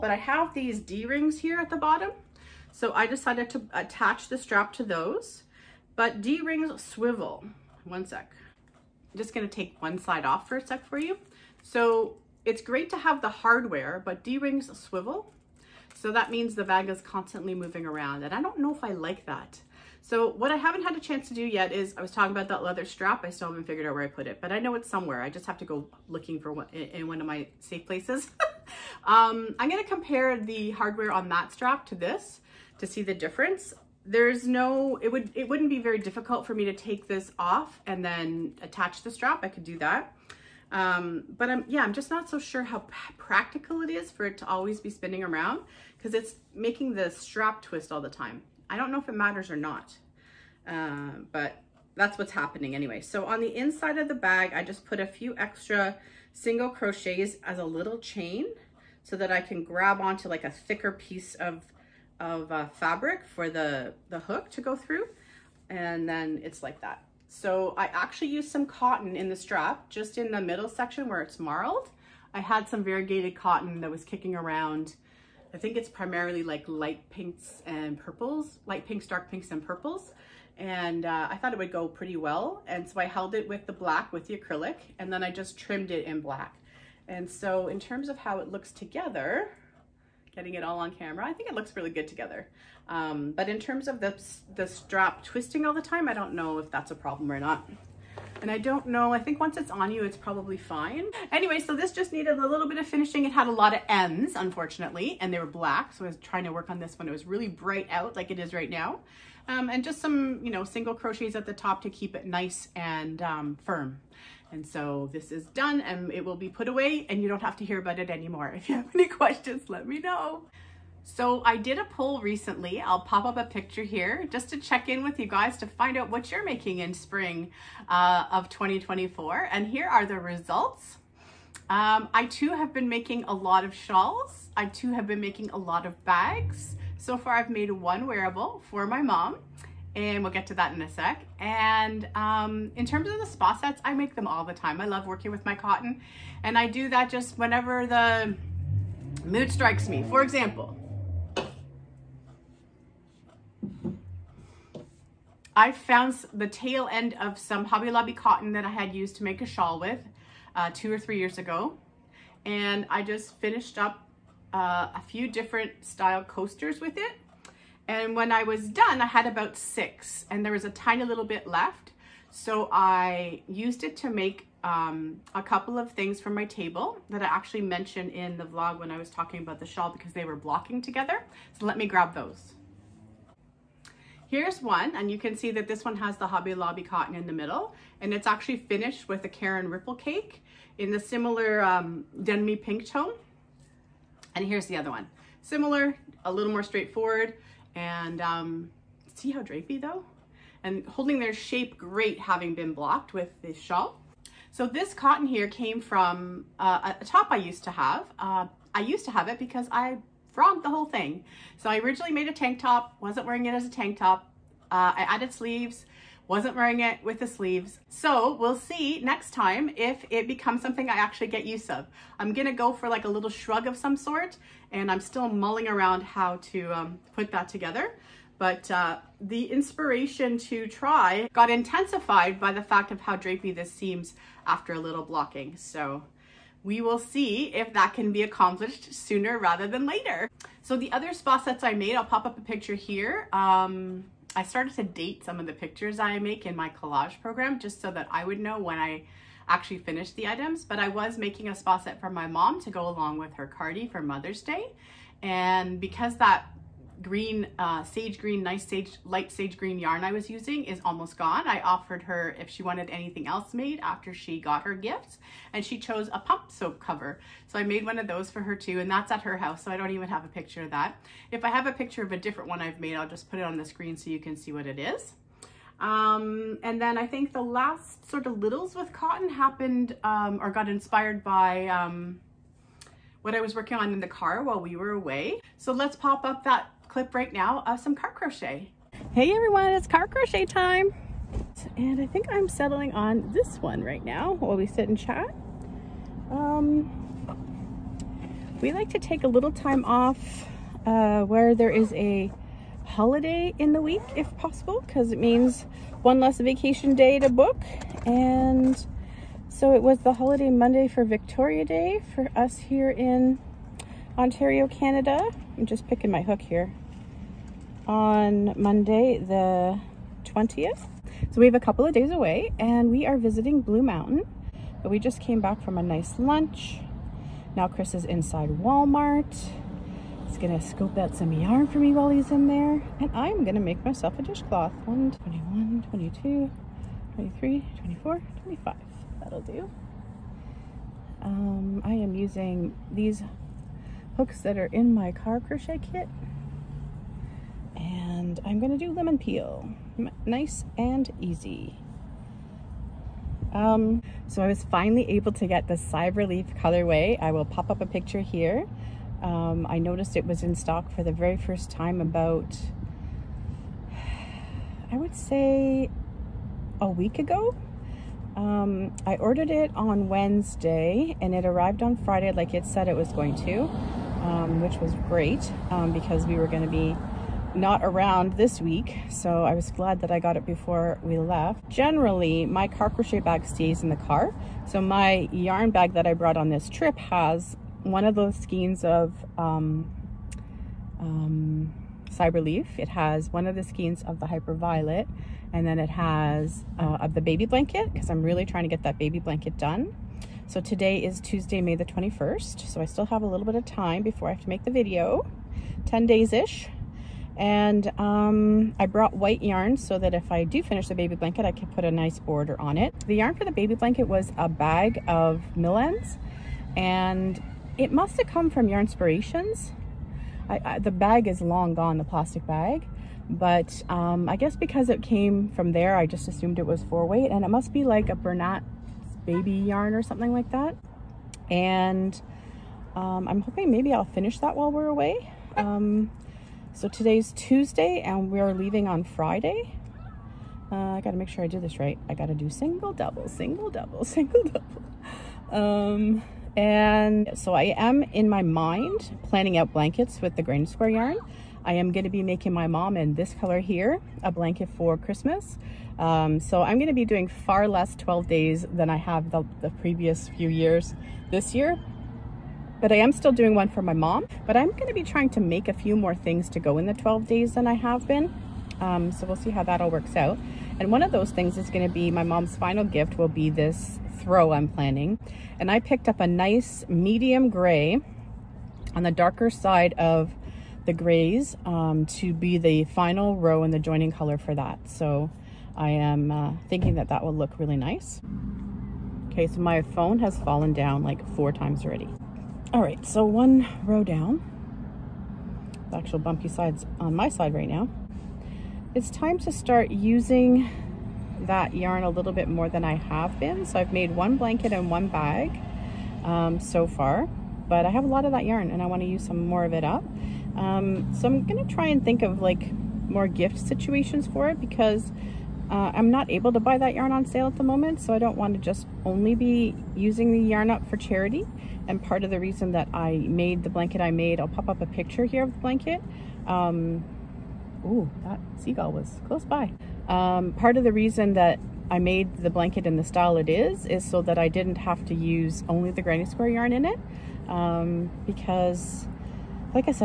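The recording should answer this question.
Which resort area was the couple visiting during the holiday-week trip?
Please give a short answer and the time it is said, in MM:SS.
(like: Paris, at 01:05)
Blue Mountain, at 05:23.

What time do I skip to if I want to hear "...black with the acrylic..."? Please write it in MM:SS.
01:23.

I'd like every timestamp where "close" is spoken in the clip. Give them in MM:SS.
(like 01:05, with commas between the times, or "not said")
08:49.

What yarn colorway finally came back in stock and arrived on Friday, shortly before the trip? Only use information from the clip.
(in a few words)
Cyber Leaf.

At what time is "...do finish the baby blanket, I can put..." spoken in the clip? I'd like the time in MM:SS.
06:50.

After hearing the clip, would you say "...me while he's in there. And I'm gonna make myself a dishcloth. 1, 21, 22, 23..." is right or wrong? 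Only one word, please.
right.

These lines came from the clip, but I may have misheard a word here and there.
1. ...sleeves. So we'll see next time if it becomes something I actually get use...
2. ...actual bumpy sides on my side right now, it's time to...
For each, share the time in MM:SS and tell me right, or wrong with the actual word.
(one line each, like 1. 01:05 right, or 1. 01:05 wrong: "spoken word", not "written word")
1. 03:37 right
2. 08:15 right.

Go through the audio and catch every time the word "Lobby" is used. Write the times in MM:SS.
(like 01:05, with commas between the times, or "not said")
02:37, 03:06.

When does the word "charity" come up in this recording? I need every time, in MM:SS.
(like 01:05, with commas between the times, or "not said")
08:40.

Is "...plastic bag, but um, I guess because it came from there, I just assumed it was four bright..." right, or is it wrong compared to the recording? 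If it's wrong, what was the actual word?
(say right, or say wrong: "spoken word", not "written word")
wrong: "weight", not "bright".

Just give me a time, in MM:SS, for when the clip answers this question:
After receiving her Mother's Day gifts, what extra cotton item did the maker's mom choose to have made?
04:26.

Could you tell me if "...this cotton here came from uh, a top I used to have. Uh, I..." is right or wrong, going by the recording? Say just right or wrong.
right.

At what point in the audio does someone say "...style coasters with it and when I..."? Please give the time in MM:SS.
02:45.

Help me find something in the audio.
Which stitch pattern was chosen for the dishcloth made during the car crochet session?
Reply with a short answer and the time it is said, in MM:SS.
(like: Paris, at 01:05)
lemon peel, at 05:48.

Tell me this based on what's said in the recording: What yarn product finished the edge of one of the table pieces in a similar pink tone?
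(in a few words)
Caron Ripple cake.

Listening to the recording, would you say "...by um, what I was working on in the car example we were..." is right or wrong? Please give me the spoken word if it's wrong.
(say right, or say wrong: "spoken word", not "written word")
wrong: "while", not "example".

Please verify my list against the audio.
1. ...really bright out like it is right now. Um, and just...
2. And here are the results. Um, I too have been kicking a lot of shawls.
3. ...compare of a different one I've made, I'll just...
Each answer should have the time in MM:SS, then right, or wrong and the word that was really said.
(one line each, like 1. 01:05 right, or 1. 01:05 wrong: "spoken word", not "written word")
1. 01:47 right
2. 02:09 wrong: "making", not "kicking"
3. 04:31 wrong: "picture", not "compare".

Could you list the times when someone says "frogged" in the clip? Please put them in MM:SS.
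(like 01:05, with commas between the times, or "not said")
03:30.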